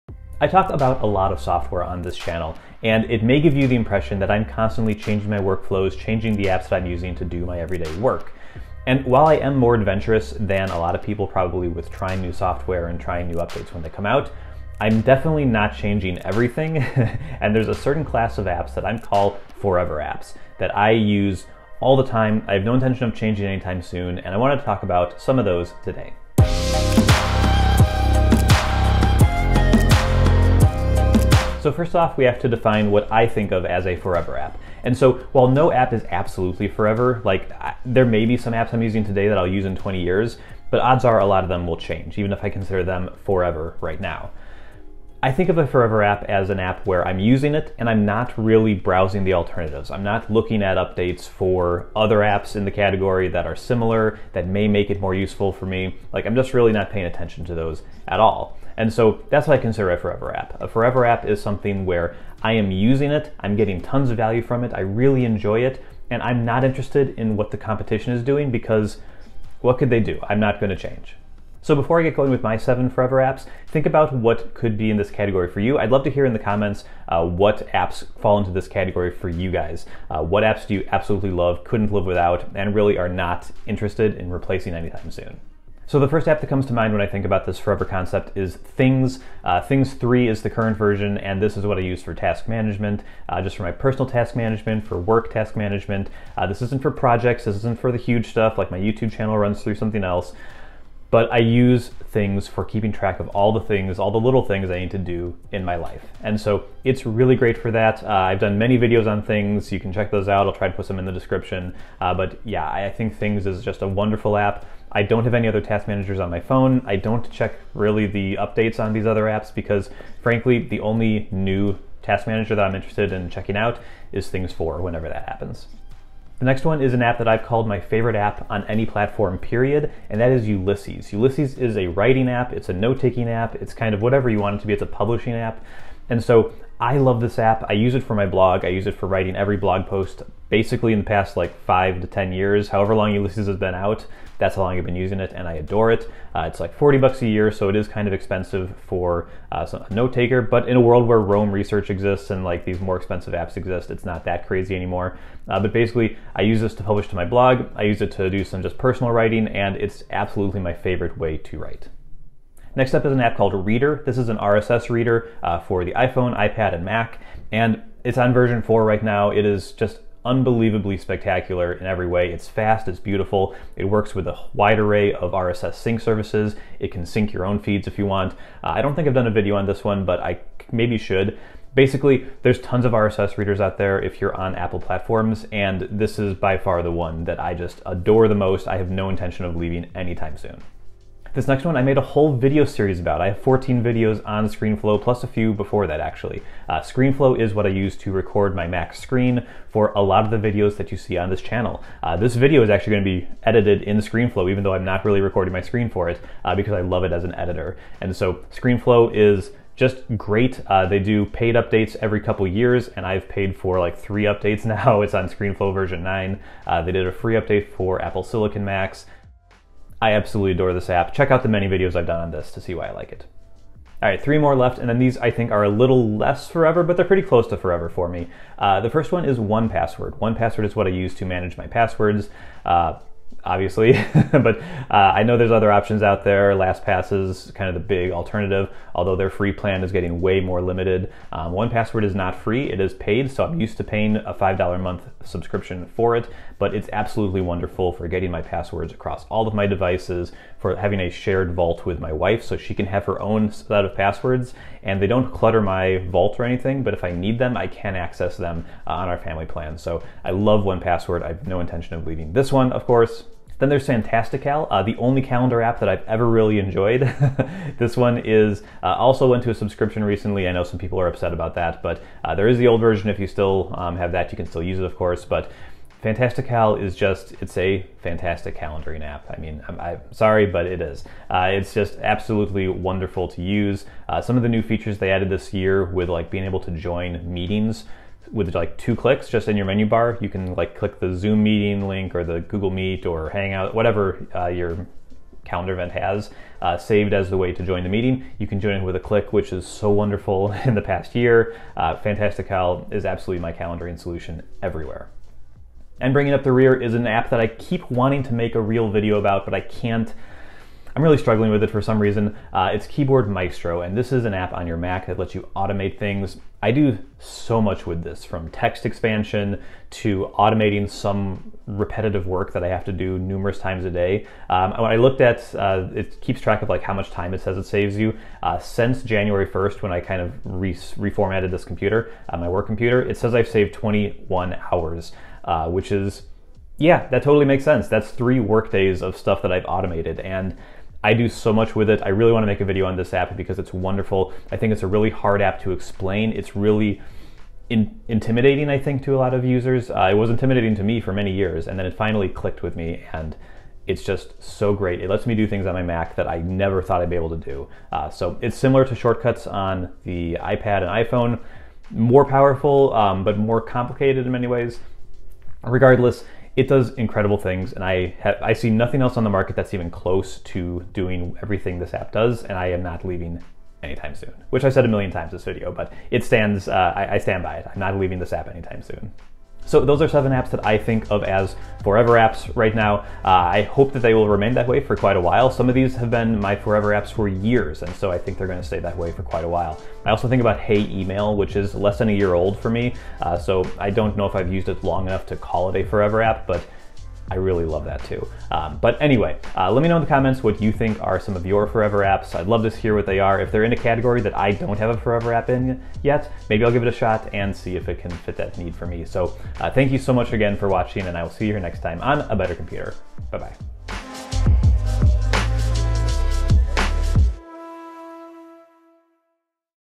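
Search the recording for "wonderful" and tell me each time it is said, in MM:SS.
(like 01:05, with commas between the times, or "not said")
01:53, 04:07, 04:42, 04:59, 05:43.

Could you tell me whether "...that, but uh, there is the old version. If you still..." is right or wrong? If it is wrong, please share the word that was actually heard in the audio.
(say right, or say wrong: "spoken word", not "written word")
right.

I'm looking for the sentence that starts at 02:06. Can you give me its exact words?
The next one is an app that I've called my favorite app on any platform, period, and that is Ulysses.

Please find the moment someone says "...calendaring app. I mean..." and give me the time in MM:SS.
04:38.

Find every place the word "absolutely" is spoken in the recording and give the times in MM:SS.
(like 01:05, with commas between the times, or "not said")
00:36, 01:20, 02:40, 03:40, 04:06, 04:42, 05:03.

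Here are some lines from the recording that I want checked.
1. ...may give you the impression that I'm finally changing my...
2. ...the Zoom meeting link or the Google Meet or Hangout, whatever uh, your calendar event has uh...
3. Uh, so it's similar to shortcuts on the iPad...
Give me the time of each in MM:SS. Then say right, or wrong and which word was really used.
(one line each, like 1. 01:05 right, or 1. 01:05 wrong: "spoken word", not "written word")
1. 00:03 wrong: "constantly", not "finally"
2. 04:50 right
3. 05:57 right.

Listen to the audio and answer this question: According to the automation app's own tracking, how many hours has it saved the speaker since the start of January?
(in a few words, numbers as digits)
21.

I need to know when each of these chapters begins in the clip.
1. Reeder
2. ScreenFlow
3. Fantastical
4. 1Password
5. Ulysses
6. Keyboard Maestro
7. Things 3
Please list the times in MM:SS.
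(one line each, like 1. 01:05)
1. 02:42
2. 03:11
3. 04:23
4. 03:48
5. 02:06
6. 05:12
7. 01:27.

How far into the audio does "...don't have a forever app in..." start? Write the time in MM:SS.
06:44.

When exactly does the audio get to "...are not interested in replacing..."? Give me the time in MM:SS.
01:22.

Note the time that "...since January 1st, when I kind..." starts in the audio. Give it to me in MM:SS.
05:28.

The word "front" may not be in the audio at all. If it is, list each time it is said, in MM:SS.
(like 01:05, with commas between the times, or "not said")
not said.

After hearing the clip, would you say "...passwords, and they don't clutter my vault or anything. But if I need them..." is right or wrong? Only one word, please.
right.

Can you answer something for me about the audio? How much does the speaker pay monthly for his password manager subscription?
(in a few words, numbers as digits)
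$5.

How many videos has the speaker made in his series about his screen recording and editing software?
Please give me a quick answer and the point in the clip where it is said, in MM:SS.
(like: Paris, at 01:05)
14, at 03:13.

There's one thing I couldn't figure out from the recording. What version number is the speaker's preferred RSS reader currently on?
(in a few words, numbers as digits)
4.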